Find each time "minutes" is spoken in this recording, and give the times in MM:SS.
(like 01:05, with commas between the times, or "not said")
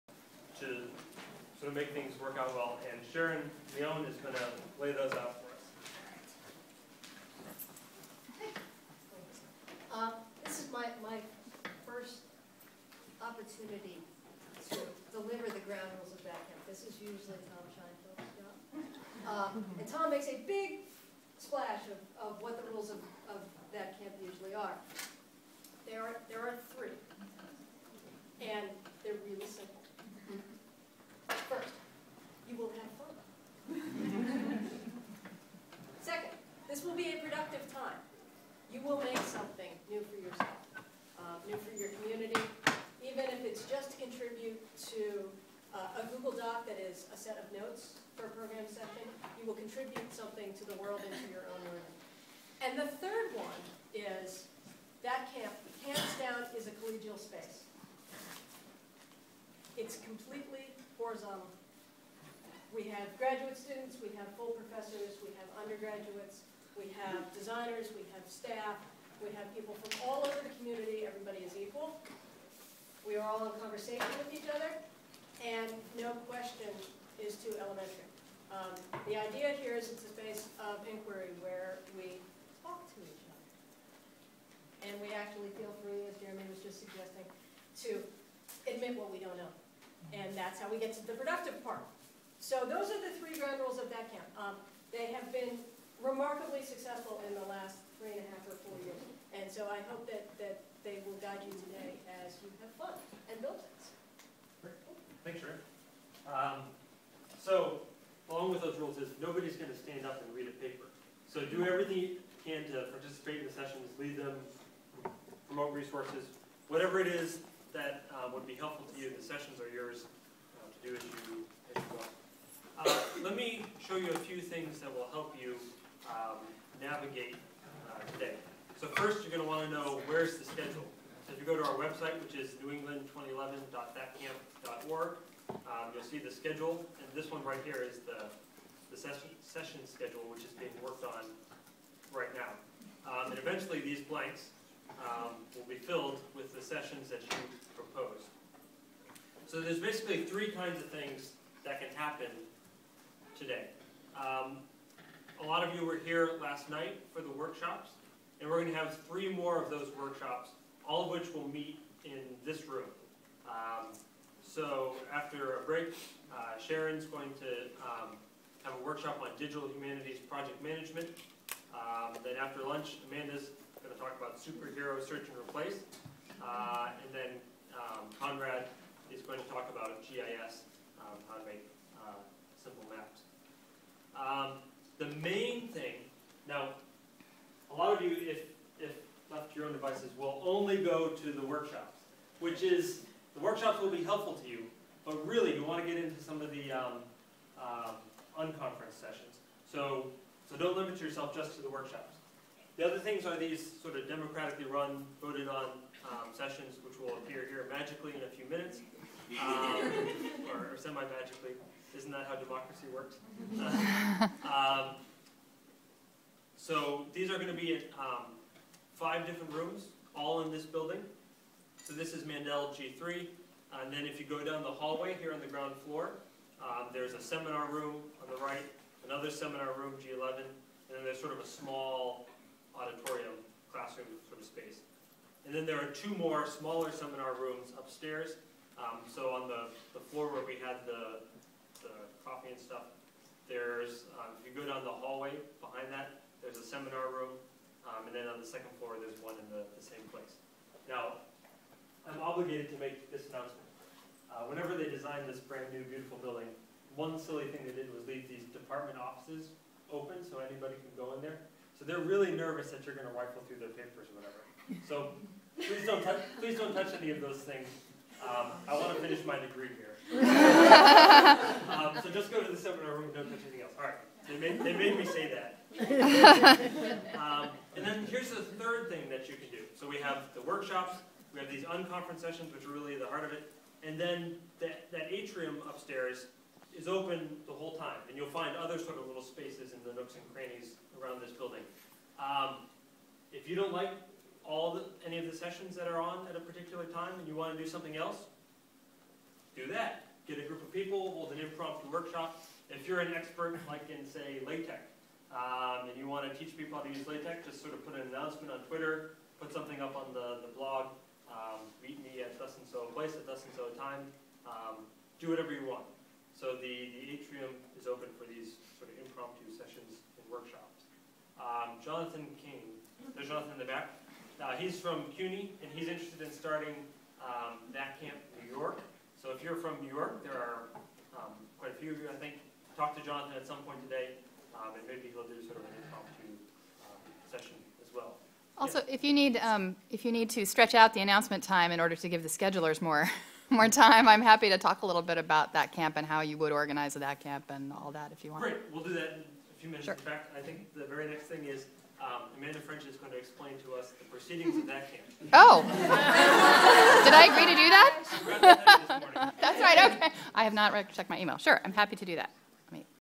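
03:28, 05:49.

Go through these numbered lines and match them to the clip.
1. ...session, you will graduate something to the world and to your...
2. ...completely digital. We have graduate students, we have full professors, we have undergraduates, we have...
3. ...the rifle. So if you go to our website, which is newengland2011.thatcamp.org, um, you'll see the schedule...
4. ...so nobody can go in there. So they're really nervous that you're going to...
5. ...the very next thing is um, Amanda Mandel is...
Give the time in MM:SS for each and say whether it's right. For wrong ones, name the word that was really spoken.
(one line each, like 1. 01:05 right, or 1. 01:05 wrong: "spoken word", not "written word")
1. 00:48 wrong: "contribute", not "graduate"
2. 01:00 wrong: "horizontal", not "digital"
3. 02:10 wrong: "schedule", not "rifle"
4. 04:20 wrong: "anybody", not "nobody"
5. 05:50 wrong: "French", not "Mandel".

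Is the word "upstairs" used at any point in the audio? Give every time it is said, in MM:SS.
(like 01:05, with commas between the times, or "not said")
03:57, 04:45.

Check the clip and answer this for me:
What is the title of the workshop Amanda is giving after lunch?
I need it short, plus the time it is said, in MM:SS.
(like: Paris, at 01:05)
Superhero search and replace, at 02:54.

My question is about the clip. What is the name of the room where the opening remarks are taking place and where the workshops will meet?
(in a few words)
Mandel G3.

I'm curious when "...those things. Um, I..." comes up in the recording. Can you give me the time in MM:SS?
04:27.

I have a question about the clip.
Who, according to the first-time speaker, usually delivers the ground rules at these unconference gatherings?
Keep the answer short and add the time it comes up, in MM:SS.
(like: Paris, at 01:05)
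Tom Scheinfeldt, at 00:17.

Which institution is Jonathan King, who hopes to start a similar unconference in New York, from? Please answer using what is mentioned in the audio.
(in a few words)
CUNY.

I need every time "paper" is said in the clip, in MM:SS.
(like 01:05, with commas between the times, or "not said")
01:50, 04:23.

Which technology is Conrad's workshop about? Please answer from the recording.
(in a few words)
GIS.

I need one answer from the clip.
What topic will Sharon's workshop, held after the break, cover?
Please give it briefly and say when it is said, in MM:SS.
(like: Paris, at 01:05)
Digital humanities project management, at 02:49.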